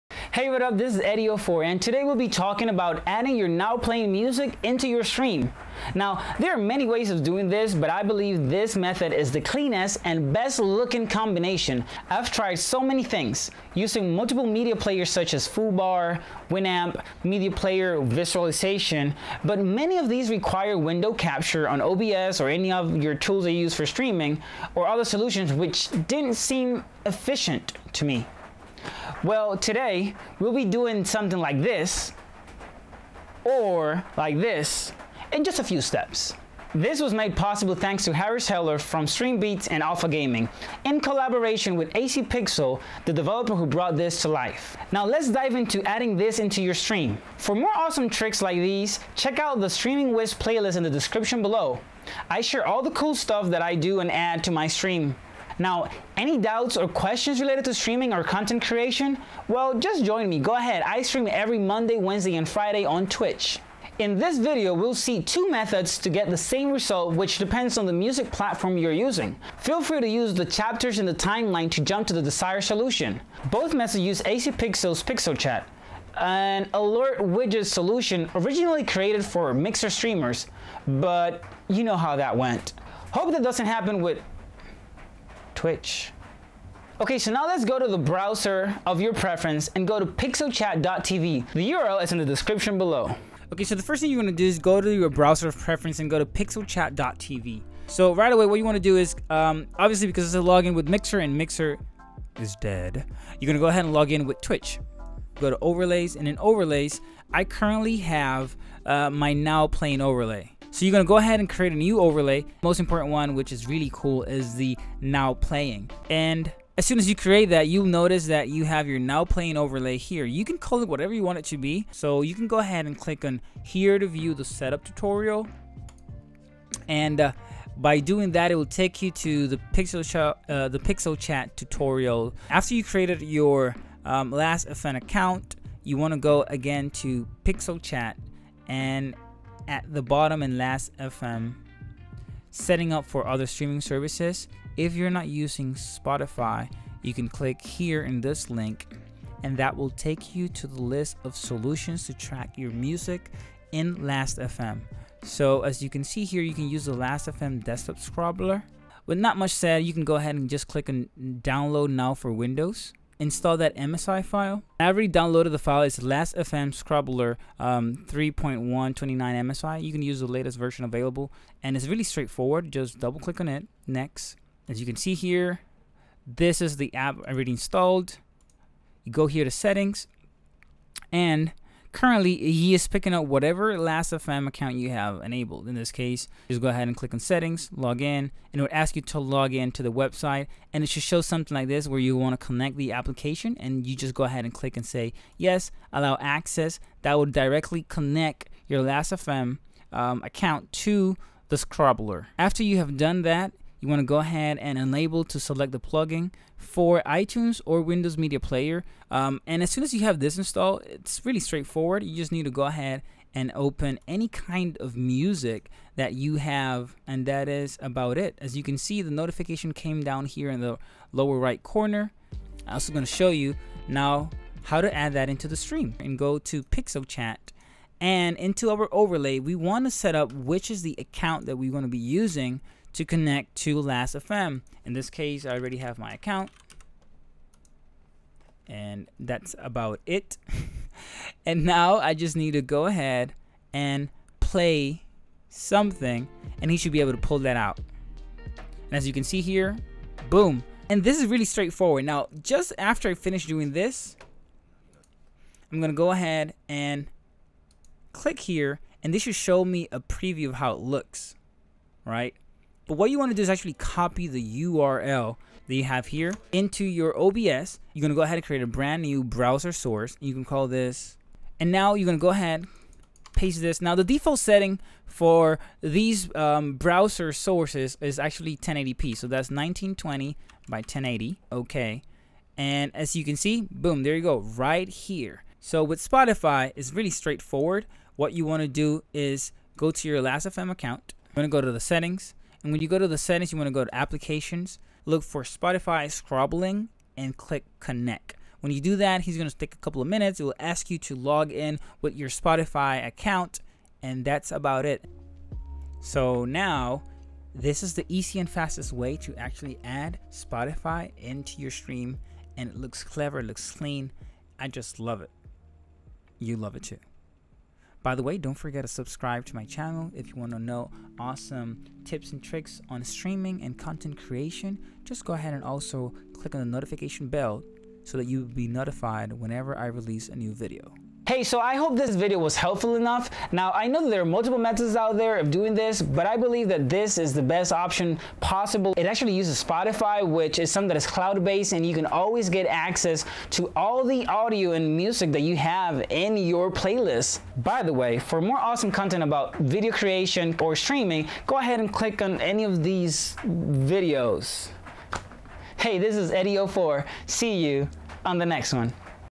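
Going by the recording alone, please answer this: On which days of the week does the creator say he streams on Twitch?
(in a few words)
Monday, Wednesday, and Friday.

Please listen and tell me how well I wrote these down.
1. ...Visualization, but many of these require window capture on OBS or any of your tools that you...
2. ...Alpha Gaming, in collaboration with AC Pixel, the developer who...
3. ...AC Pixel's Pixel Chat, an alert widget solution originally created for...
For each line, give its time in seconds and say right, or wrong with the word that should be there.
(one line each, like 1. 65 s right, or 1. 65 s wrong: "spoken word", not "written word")
1. 17 s right
2. 39 s right
3. 74 s right.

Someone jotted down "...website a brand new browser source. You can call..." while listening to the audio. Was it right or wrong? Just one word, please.
wrong.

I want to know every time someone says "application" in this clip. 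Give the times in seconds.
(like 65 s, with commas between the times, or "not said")
192 s, 293 s.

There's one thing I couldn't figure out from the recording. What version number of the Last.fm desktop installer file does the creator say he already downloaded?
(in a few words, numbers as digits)
3.129.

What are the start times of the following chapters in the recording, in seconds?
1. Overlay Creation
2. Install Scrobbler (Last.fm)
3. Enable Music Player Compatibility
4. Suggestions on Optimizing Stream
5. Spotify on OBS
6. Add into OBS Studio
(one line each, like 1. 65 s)
1. 114 s
2. 160 s
3. 200 s
4. 331 s
5. 32 s
6. 258 s.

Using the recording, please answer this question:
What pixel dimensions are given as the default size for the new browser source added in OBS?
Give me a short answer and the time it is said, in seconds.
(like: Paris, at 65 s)
1920 by 1080, at 279 s.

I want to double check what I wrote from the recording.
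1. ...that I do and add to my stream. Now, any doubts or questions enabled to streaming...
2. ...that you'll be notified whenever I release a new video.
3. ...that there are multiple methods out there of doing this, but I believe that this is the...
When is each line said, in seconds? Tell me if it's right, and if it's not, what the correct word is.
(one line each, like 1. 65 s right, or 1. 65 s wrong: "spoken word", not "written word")
1. 53 s wrong: "related", not "enabled"
2. 328 s right
3. 334 s right.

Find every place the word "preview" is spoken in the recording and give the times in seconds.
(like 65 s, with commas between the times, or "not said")
259 s.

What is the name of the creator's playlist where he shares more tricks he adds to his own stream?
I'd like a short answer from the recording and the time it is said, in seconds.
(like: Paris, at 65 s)
Streaming Wiz, at 49 s.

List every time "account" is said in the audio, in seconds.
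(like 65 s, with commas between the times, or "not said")
134 s, 184 s, 200 s, 230 s, 236 s, 290 s, 303 s.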